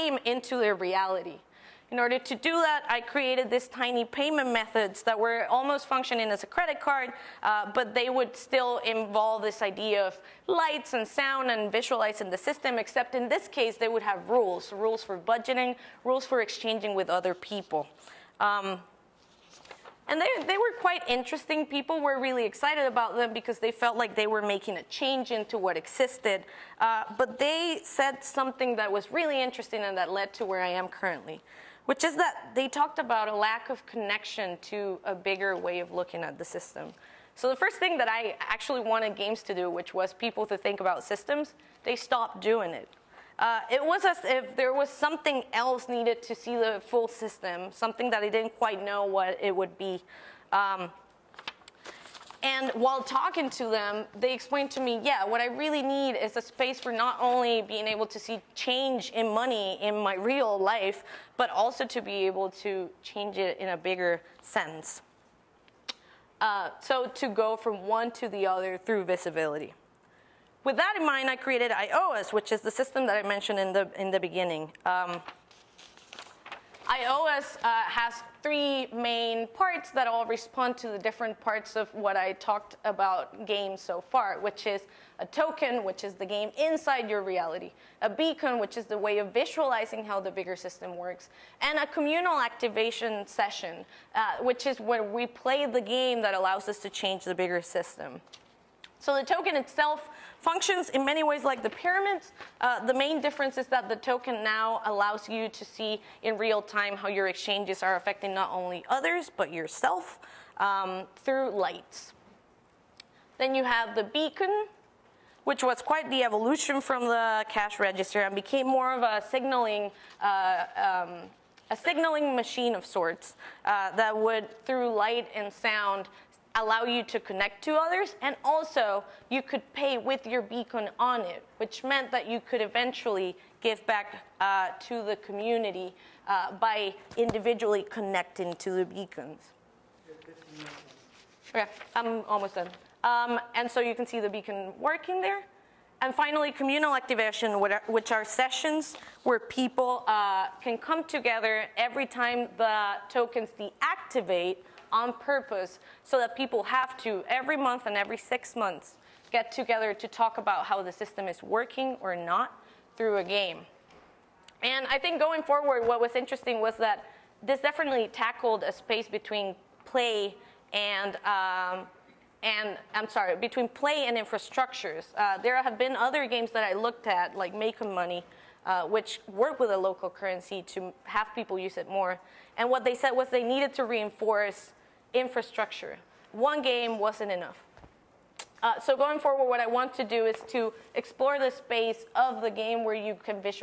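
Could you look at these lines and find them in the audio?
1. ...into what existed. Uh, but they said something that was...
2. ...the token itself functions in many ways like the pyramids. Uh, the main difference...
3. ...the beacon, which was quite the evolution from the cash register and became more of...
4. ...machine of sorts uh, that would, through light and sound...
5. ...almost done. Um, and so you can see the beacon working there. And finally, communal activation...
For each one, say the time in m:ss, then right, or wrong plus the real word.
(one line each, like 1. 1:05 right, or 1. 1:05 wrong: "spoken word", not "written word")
1. 0:25 right
2. 1:39 right
3. 1:53 right
4. 2:02 right
5. 2:22 right.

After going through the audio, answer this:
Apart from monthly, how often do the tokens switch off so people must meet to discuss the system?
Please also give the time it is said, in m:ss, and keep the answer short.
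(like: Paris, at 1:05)
Every six months, at 2:37.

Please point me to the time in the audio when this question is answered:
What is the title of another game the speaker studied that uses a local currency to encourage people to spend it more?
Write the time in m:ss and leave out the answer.
2:57.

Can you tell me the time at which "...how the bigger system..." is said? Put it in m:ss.
1:30.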